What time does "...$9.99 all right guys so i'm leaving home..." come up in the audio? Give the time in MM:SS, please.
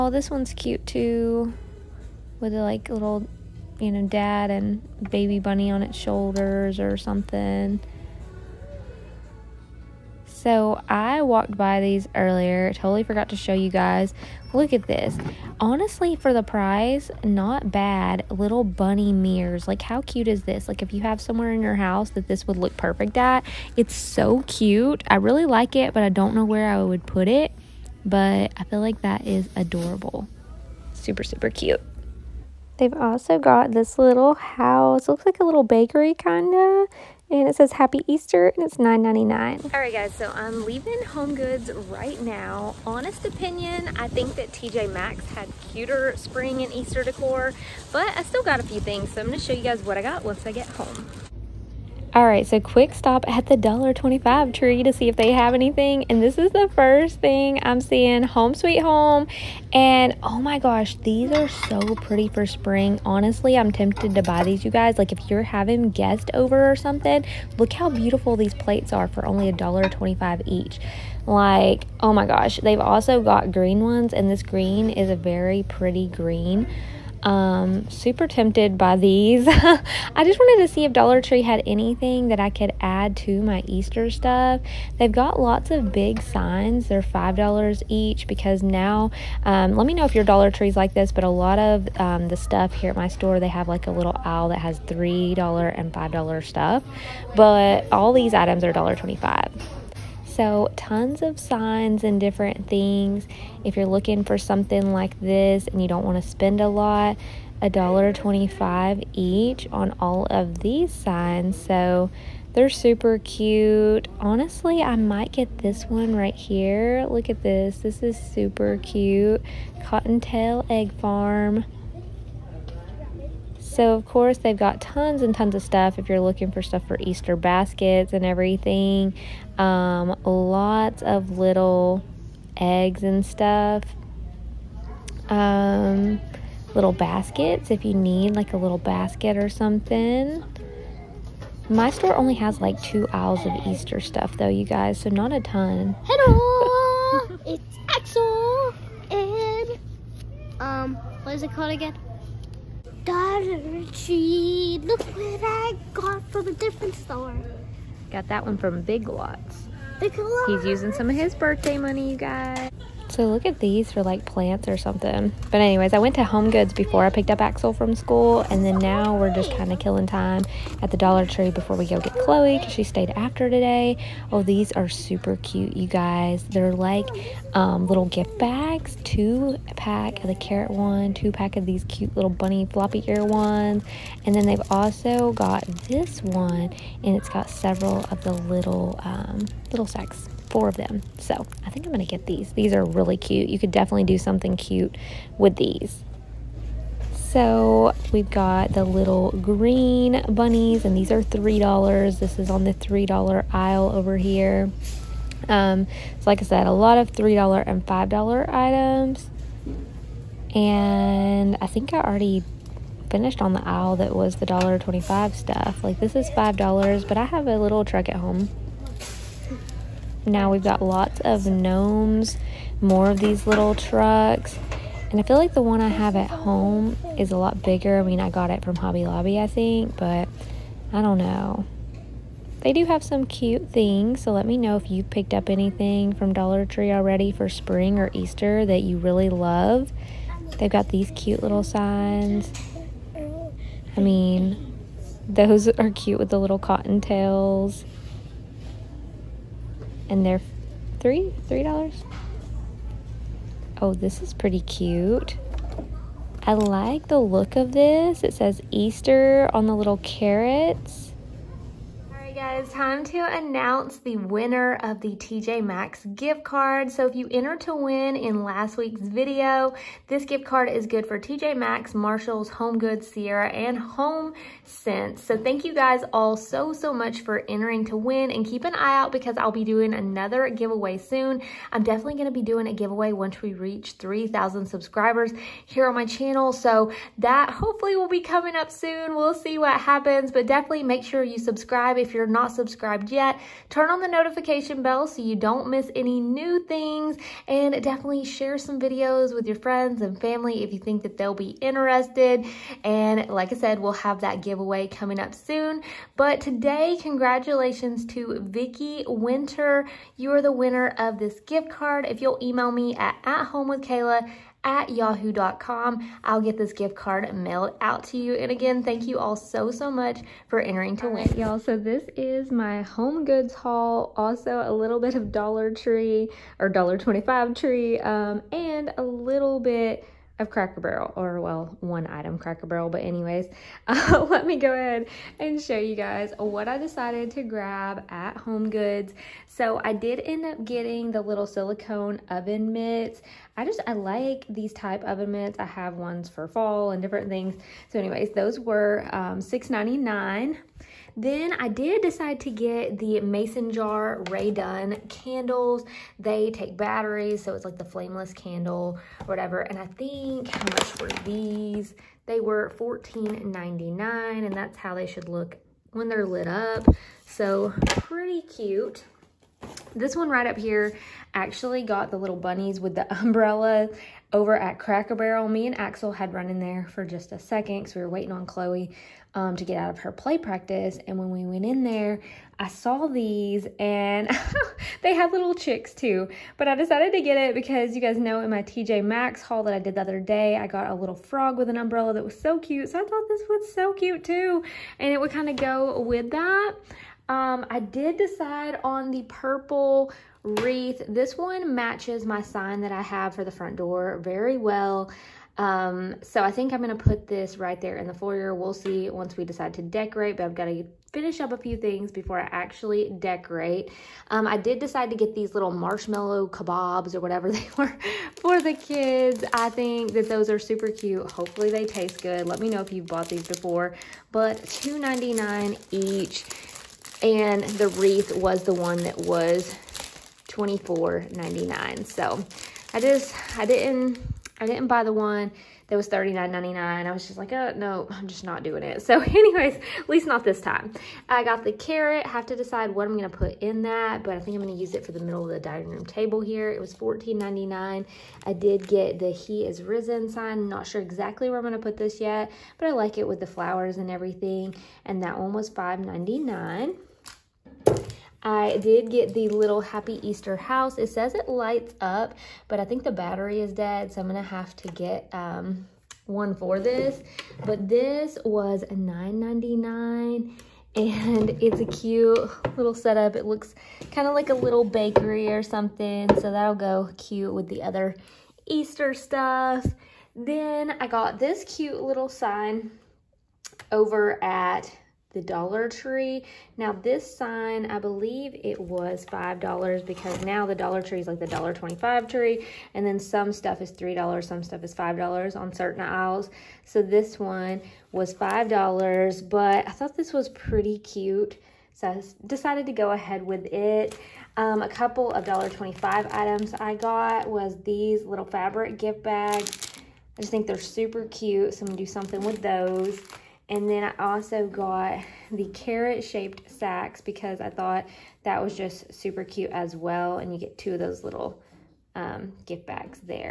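00:38.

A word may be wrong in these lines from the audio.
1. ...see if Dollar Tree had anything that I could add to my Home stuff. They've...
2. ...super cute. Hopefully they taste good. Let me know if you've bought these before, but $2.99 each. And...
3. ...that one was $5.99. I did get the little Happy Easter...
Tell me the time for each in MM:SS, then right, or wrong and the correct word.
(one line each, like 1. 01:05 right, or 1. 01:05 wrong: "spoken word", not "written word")
1. 01:20 wrong: "Easter", not "Home"
2. 07:00 right
3. 07:35 right.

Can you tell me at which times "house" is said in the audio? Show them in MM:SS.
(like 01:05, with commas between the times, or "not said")
00:21, 00:34, 07:40.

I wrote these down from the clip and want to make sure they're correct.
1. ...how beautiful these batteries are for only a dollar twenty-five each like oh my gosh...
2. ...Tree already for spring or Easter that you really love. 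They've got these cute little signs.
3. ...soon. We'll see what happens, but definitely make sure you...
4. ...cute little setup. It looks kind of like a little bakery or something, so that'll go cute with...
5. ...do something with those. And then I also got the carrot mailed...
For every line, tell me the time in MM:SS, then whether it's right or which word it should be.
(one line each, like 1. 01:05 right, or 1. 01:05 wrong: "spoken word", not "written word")
1. 01:07 wrong: "plates", not "batteries"
2. 03:56 right
3. 04:48 right
4. 07:51 right
5. 08:31 wrong: "shaped", not "mailed".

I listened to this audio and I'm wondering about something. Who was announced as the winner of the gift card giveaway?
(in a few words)
Vicki Winter.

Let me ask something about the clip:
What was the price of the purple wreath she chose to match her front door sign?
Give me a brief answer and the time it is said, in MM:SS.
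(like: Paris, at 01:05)
$24.99, at 07:10.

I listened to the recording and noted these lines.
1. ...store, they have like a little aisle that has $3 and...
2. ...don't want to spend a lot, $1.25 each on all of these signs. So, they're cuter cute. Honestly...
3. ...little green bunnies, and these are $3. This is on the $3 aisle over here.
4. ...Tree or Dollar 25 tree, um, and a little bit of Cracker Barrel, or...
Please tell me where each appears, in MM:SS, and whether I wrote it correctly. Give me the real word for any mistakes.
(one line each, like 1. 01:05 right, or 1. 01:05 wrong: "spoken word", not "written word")
1. 01:33 right
2. 01:45 wrong: "super", not "cuter"
3. 03:18 right
4. 05:25 right.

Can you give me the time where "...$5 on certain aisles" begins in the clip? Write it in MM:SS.
08:14.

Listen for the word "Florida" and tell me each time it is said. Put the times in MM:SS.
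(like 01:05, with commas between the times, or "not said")
not said.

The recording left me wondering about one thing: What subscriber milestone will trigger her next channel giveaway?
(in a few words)
3,000.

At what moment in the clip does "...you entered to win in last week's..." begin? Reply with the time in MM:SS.
04:27.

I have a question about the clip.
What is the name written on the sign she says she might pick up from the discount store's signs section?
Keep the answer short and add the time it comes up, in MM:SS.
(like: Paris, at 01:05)
Cottontail Egg Farm, at 01:59.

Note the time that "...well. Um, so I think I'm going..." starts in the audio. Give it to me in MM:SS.
06:44.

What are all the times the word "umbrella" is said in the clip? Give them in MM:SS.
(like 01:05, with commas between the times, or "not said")
06:13, 06:31.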